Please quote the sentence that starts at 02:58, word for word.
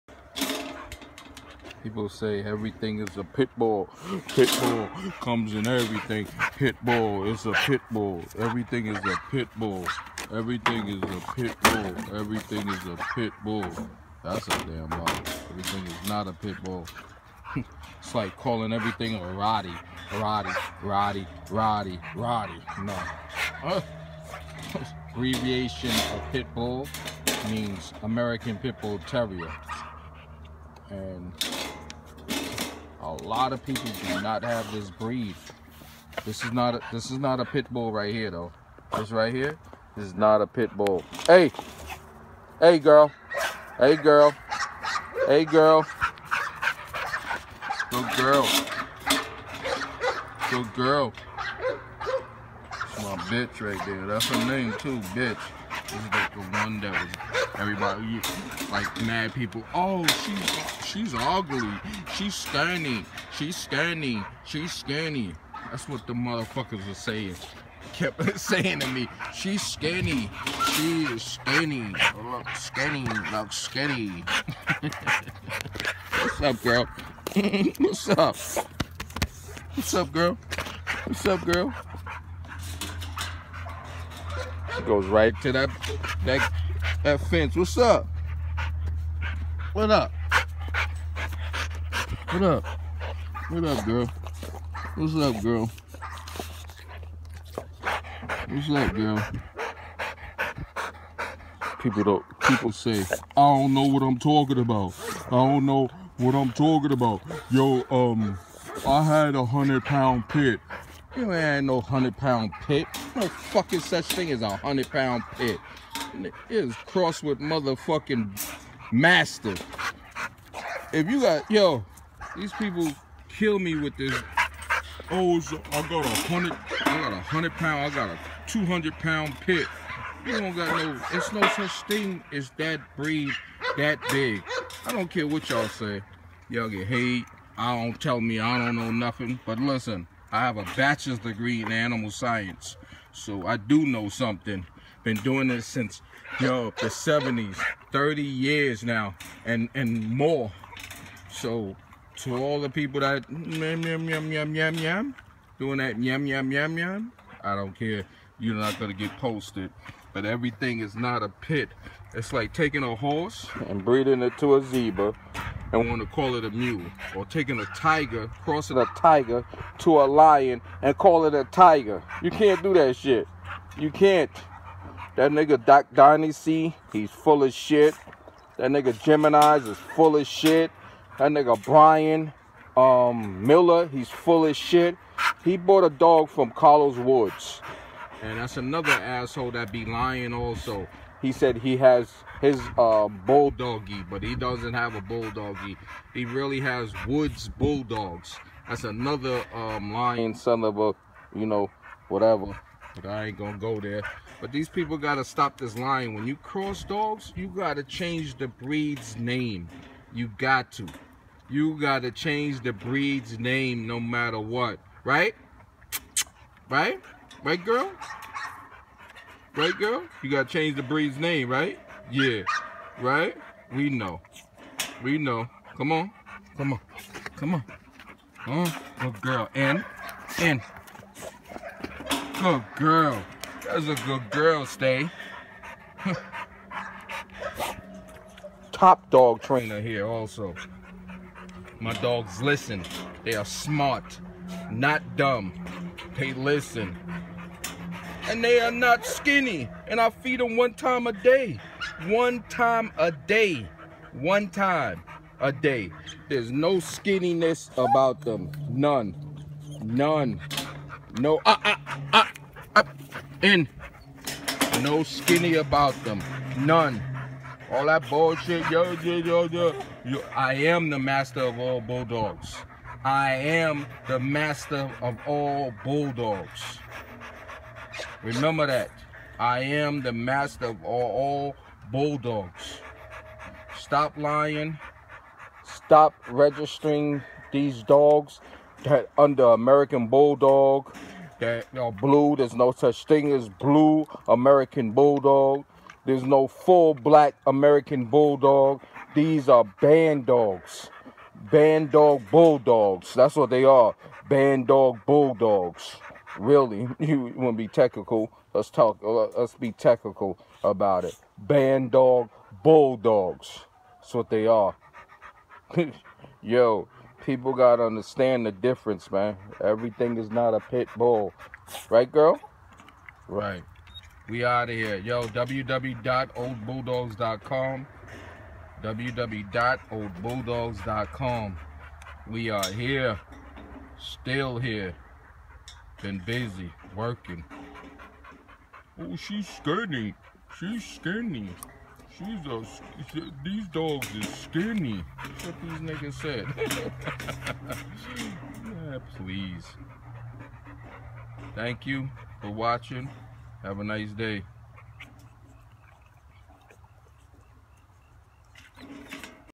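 That nigga Gemini's is full of shit.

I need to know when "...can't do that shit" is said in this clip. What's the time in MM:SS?
02:52.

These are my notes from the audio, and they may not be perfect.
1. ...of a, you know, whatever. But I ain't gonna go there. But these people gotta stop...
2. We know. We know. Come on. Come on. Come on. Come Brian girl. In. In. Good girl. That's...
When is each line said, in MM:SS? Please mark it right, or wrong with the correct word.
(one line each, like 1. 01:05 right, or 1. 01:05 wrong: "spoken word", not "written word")
1. 03:20 right
2. 03:43 wrong: "Good", not "Brian".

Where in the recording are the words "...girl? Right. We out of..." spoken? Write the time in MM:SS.
05:22.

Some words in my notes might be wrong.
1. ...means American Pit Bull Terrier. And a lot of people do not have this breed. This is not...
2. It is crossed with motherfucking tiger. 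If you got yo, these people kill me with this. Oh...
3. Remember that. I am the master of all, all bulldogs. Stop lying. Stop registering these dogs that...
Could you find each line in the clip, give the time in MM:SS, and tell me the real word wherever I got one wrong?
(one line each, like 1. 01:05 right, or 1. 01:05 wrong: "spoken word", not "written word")
1. 00:27 right
2. 01:56 wrong: "master", not "tiger"
3. 04:38 right.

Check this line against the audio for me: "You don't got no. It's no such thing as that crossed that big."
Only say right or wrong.
wrong.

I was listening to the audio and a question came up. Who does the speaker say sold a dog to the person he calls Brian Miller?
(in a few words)
Carlos Woods.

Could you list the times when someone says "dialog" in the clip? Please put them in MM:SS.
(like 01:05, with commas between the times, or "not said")
not said.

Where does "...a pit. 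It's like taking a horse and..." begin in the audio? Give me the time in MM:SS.
02:41.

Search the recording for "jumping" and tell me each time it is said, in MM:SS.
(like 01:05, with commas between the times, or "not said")
not said.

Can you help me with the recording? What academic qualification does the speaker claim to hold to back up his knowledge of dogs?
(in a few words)
Bachelor's degree in animal science.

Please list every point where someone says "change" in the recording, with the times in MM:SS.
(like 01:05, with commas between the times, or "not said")
03:27, 03:32, 03:40.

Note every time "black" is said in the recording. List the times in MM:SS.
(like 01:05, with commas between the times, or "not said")
04:56.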